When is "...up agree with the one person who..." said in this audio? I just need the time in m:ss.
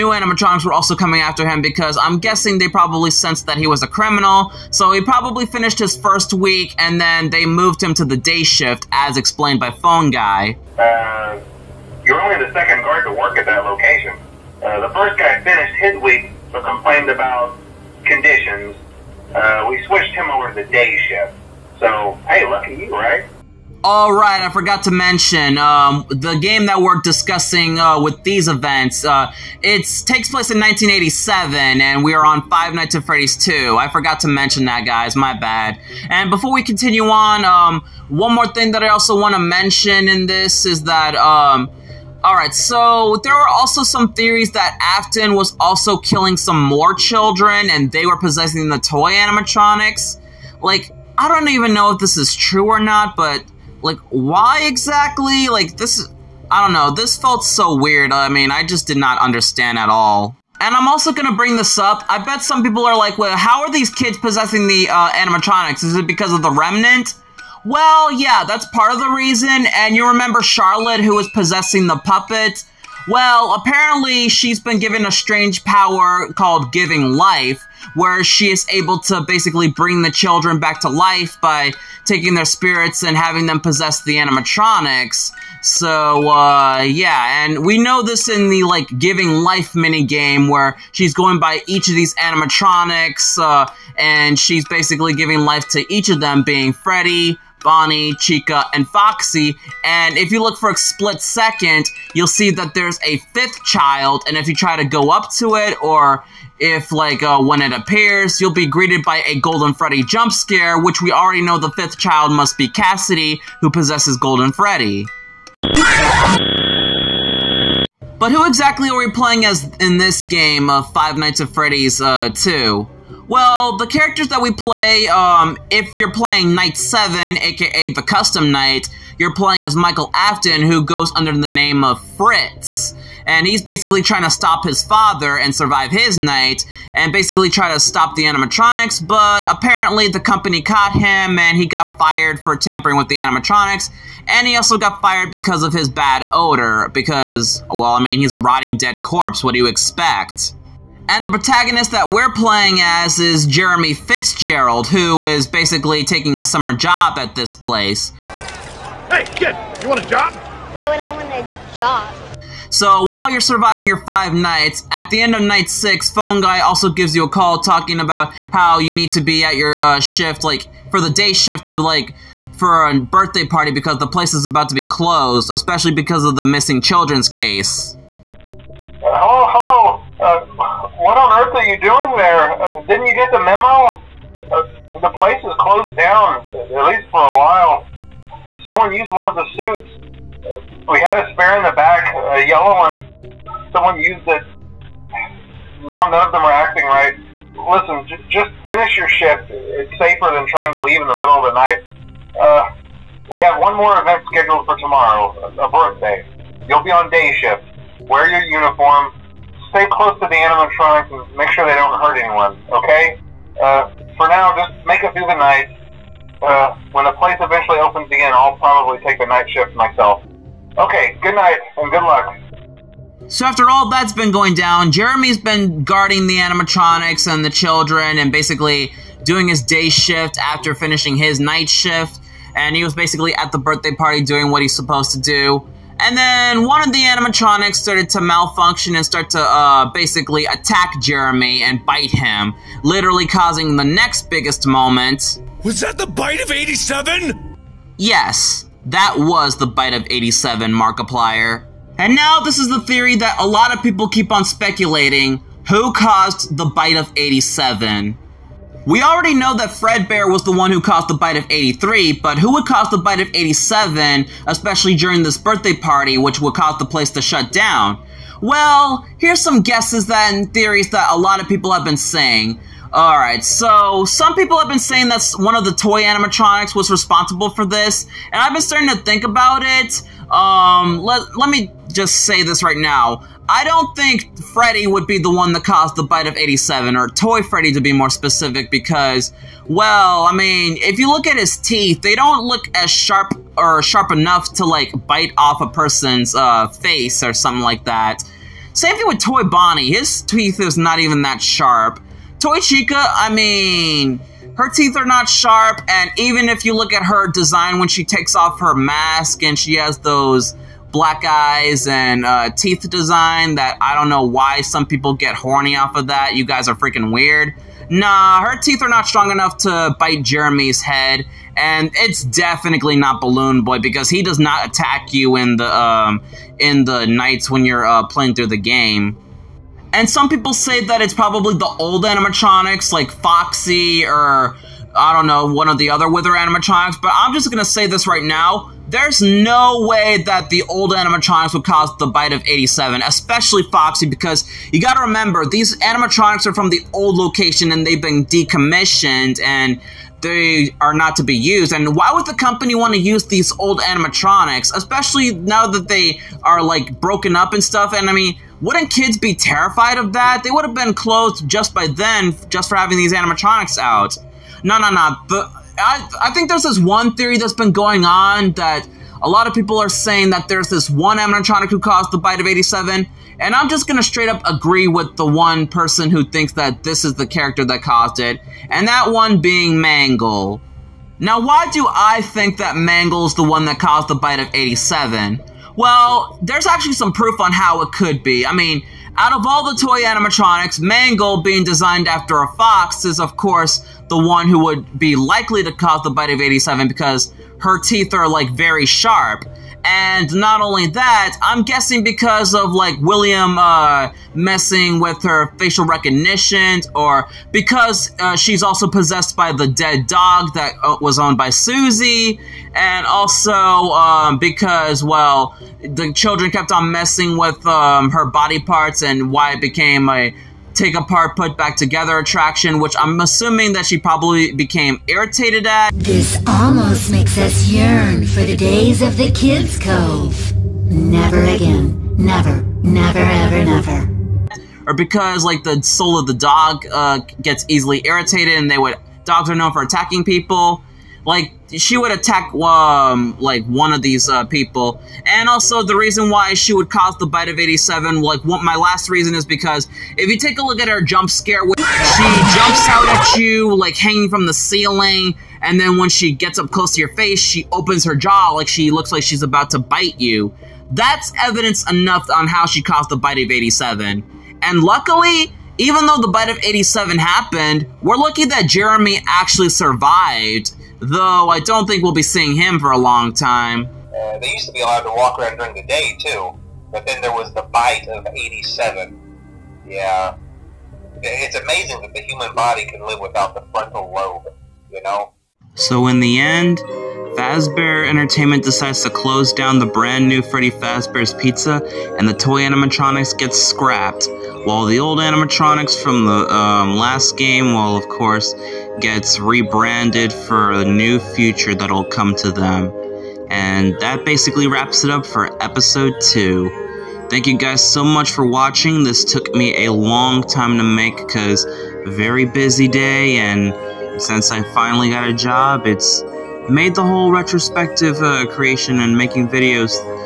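6:14.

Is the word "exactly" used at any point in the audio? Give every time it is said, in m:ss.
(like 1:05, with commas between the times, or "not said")
0:54, 1:58.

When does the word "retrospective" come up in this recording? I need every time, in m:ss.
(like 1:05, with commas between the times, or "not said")
8:37.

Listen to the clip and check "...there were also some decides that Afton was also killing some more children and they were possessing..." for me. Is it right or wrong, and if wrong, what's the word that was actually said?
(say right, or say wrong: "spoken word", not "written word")
wrong: "theories", not "decides".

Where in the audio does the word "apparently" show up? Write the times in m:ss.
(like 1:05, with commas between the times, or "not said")
1:13, 2:19.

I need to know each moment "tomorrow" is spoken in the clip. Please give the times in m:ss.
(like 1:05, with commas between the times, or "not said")
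3:24.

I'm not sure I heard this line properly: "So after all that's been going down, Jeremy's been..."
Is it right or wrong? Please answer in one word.
right.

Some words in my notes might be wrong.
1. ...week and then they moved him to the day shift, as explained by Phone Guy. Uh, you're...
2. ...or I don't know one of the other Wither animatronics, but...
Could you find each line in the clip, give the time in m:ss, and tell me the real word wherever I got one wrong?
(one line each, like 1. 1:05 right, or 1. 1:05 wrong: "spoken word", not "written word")
1. 0:06 right
2. 5:34 right.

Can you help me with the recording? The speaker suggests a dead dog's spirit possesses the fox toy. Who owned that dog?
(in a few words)
Susie.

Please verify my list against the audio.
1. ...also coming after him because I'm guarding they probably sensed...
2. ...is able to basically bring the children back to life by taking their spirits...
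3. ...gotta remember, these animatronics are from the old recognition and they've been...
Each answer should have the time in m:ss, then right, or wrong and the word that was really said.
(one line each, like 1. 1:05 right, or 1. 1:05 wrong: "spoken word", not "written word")
1. 0:00 wrong: "guessing", not "guarding"
2. 1:18 right
3. 5:44 wrong: "location", not "recognition".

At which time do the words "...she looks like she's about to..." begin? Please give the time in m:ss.
7:38.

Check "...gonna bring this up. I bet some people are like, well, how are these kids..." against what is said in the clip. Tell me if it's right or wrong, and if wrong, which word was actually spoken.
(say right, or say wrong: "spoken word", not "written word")
right.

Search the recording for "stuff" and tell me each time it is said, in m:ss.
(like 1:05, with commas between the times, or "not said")
5:57.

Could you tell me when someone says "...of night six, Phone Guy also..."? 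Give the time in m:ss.
2:45.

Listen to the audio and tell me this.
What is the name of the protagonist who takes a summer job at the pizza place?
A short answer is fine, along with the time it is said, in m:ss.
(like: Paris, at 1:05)
Jeremy Fitzgerald, at 2:33.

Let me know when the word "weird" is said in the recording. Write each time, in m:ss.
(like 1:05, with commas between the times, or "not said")
0:57, 5:17.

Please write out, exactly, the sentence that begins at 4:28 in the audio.
Well, here's some guesses that, and theories that a lot of people have been saying.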